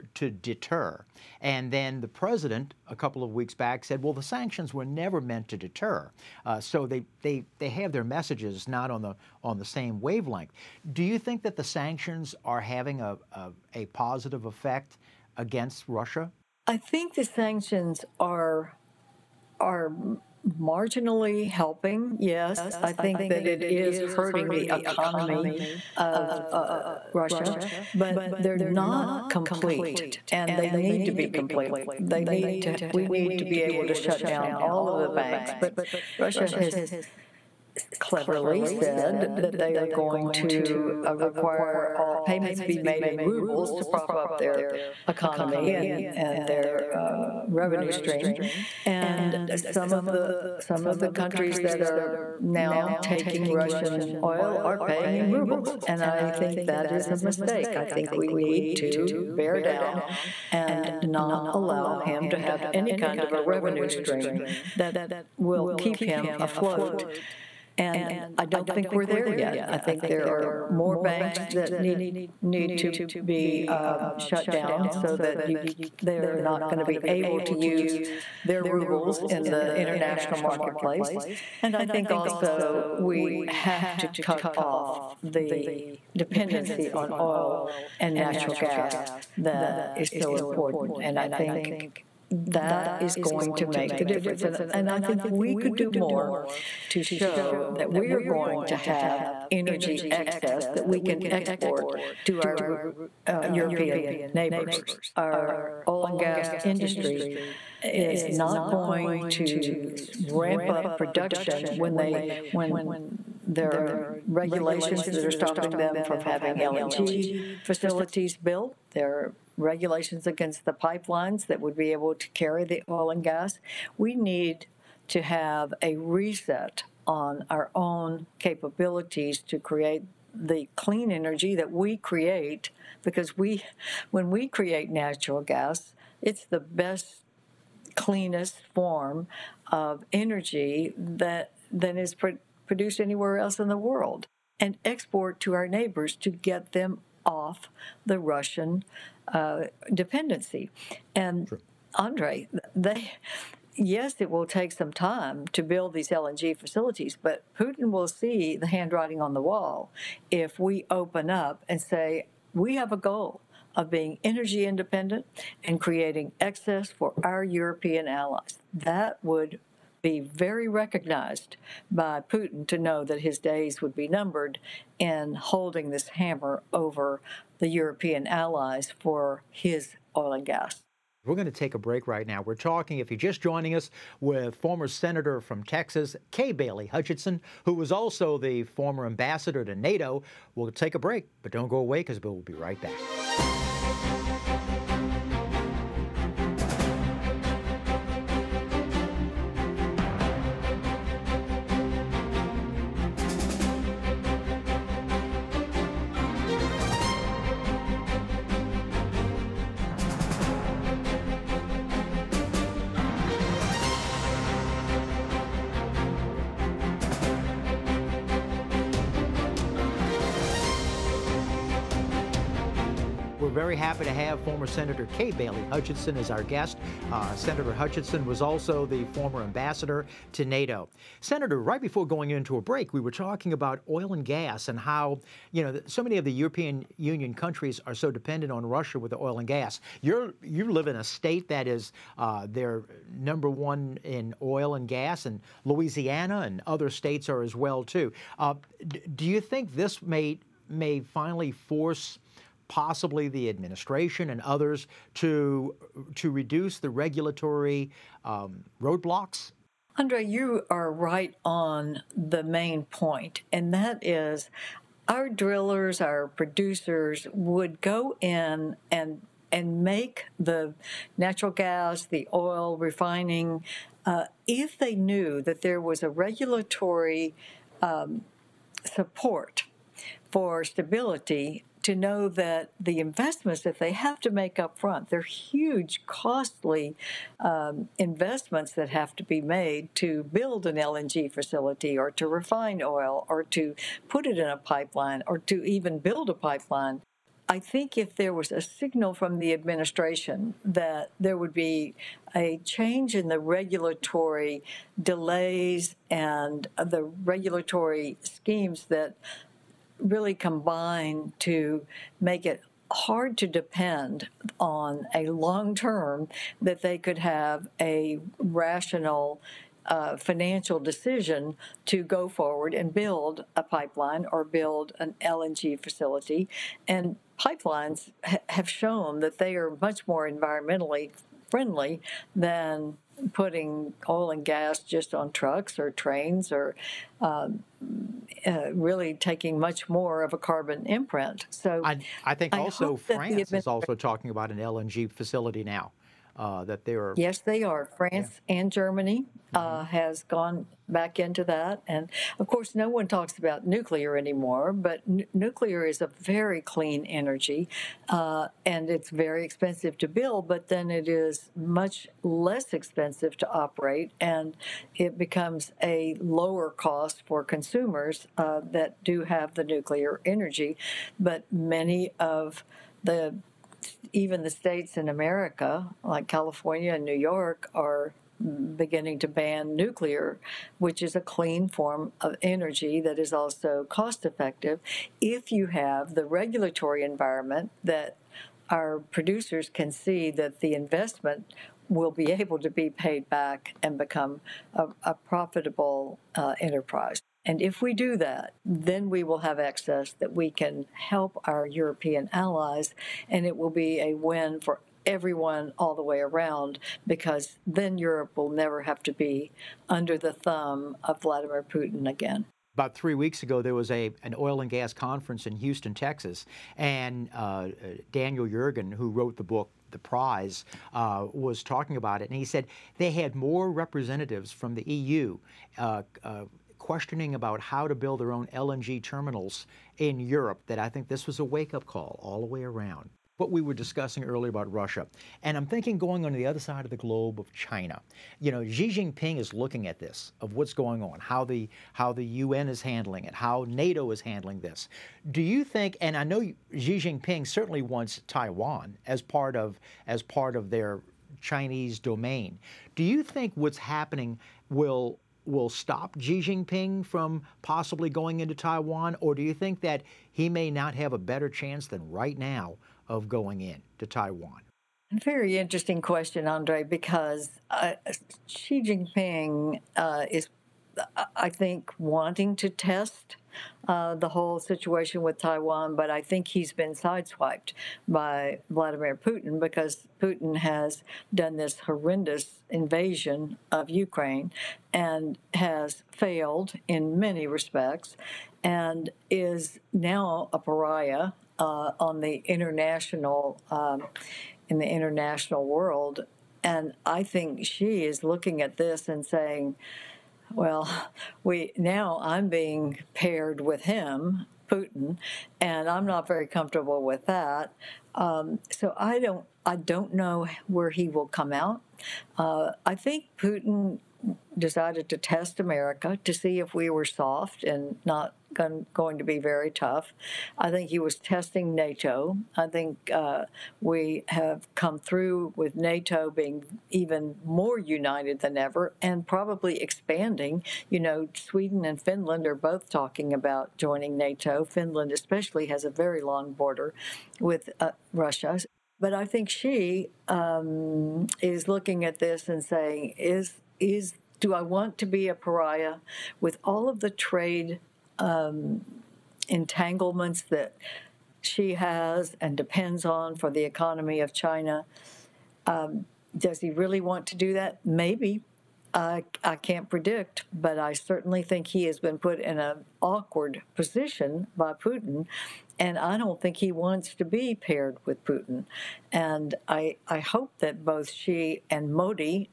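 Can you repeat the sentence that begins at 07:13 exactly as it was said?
What we were discussing earlier about Russia.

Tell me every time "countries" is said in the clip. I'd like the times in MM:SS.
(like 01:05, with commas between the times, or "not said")
00:51, 03:57.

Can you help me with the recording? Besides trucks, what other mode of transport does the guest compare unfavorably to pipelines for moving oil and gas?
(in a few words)
trains.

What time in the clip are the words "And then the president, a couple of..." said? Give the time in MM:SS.
00:01.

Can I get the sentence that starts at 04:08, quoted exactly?
Uh, do you think this may, may finally force possibly the administration and others to, to reduce the regulatory um, roadblocks?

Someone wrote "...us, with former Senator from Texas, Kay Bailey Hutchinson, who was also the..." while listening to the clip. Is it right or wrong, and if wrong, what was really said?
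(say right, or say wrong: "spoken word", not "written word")
right.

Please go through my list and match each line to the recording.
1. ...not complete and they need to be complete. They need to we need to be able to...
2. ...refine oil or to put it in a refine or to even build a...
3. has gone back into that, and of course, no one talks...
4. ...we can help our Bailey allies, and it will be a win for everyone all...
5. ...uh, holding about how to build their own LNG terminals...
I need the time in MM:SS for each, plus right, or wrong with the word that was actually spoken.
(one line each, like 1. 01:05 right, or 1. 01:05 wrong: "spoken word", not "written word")
1. 00:28 right
2. 04:52 wrong: "pipeline", not "refine"
3. 05:49 right
4. 06:40 wrong: "European", not "Bailey"
5. 07:06 wrong: "questioning", not "holding".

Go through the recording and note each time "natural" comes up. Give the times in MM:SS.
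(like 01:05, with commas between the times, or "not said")
01:28, 02:14, 04:31.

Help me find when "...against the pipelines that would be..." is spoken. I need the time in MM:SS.
02:00.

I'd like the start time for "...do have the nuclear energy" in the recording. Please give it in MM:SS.
06:09.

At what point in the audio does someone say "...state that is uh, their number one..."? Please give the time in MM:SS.
04:01.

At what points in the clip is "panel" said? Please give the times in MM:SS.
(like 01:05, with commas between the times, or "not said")
not said.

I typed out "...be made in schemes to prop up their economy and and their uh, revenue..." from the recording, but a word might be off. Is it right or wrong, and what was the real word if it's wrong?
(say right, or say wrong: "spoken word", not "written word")
wrong: "rubles", not "schemes".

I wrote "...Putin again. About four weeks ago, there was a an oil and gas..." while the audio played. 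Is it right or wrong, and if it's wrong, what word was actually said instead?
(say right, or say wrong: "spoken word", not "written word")
wrong: "three", not "four".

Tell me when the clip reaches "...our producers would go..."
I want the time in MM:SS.
04:26.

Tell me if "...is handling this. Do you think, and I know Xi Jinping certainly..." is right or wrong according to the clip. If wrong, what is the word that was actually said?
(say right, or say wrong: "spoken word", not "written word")
right.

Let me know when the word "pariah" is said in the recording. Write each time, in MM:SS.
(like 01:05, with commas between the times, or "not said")
08:10, 09:05.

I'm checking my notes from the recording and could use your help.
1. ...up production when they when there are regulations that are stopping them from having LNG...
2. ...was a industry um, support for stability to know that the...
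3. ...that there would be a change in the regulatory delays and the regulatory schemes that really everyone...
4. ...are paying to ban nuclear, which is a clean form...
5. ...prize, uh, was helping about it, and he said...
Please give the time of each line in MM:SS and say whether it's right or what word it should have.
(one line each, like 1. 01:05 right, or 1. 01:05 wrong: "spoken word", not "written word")
1. 01:50 right
2. 04:35 wrong: "regulatory", not "industry"
3. 05:00 wrong: "combine", not "everyone"
4. 06:17 wrong: "beginning", not "paying"
5. 06:59 wrong: "talking", not "helping".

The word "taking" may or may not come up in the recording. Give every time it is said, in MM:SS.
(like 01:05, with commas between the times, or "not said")
00:53, 05:39.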